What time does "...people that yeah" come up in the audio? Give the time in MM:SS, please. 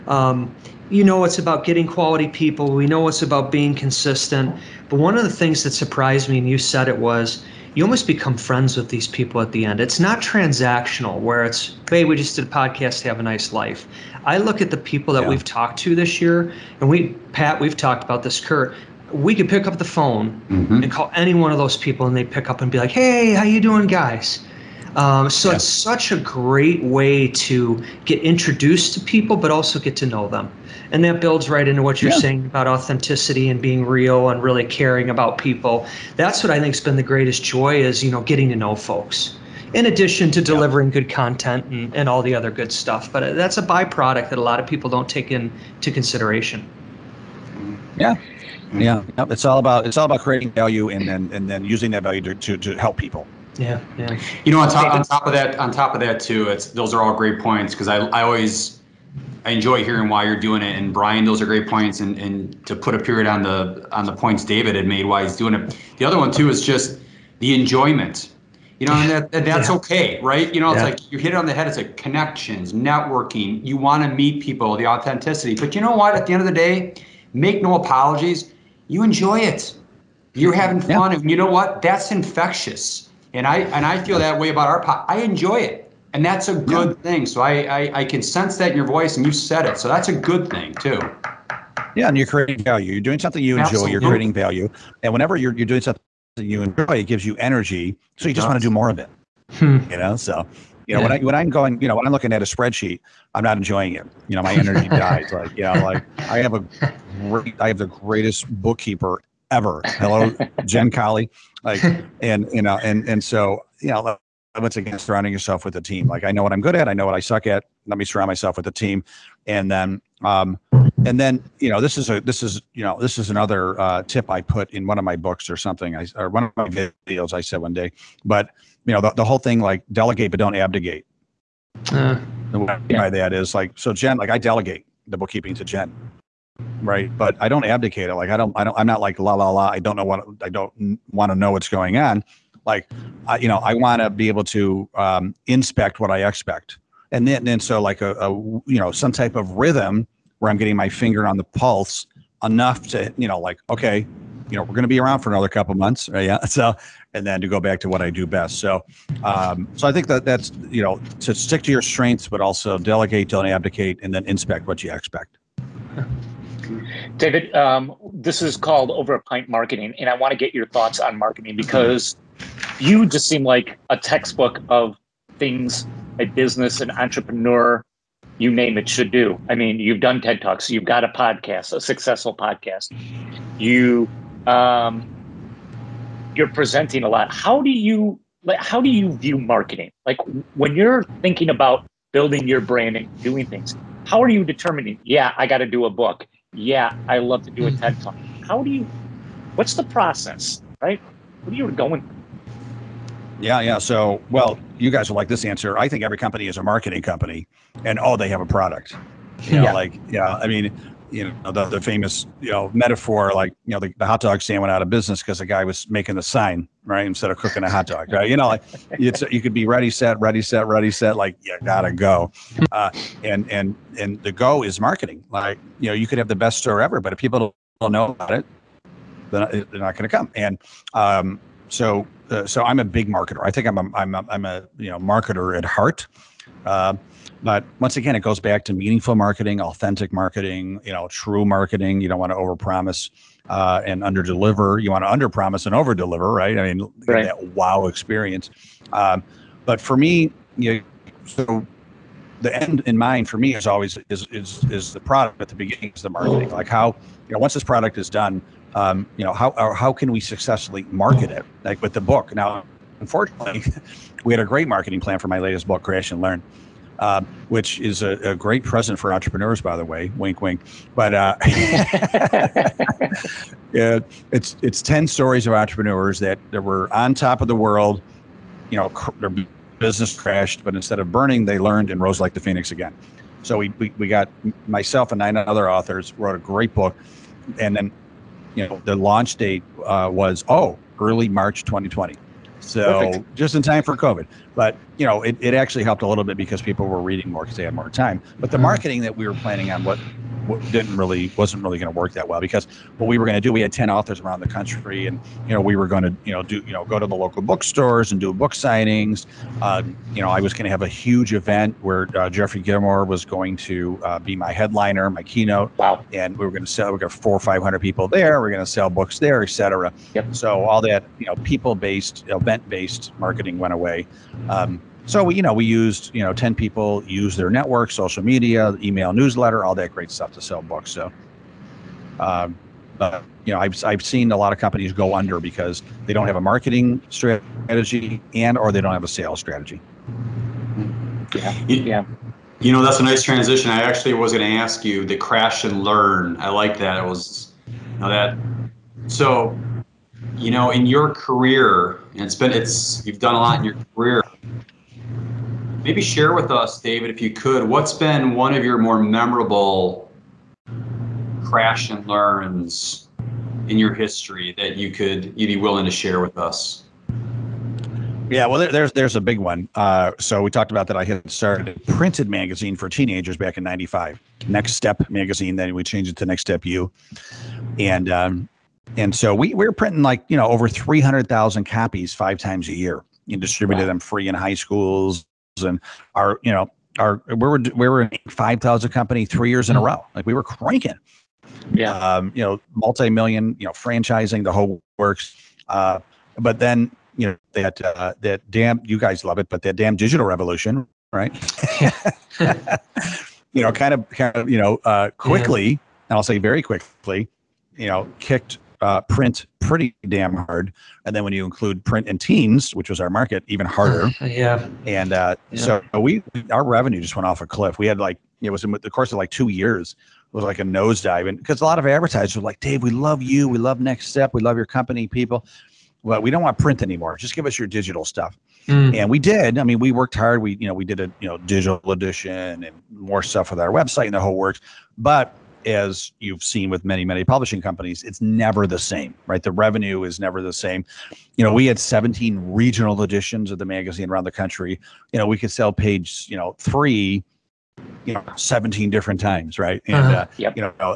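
00:14.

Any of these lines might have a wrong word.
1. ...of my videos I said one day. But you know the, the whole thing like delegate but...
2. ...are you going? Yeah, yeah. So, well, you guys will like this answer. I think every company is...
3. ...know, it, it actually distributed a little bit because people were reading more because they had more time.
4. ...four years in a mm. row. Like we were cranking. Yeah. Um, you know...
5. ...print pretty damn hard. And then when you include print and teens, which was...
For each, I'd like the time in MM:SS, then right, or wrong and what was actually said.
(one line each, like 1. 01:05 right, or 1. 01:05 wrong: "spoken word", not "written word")
1. 02:06 right
2. 03:21 right
3. 04:55 wrong: "helped", not "distributed"
4. 06:29 wrong: "three", not "four"
5. 06:49 right.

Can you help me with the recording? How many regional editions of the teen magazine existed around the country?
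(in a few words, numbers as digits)
17.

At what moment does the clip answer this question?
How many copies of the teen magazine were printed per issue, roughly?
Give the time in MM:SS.
06:20.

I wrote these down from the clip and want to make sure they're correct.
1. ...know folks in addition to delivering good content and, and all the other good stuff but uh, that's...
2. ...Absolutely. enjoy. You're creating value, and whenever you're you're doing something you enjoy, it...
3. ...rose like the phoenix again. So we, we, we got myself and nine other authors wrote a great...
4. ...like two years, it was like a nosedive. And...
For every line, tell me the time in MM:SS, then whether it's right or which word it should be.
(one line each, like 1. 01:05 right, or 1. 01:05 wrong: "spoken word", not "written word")
1. 00:38 right
2. 01:33 right
3. 04:42 right
4. 06:59 right.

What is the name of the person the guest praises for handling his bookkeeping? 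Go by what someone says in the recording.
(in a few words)
Jen Collie.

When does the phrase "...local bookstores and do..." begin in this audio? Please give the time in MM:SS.
05:07.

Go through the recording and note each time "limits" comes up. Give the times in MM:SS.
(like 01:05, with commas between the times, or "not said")
01:54.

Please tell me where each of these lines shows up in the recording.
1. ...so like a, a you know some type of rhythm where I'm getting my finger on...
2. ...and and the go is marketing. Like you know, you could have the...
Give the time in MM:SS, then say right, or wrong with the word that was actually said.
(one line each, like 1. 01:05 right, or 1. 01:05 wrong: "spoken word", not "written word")
1. 02:27 right
2. 03:43 right.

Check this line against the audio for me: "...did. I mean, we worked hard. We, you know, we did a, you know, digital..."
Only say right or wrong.
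right.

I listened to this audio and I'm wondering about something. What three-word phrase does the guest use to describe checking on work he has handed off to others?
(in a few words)
inspect what you expect.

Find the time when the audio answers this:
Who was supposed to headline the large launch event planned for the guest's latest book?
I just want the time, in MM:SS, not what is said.
05:12.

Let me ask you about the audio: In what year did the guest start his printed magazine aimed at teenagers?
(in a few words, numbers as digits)
1995.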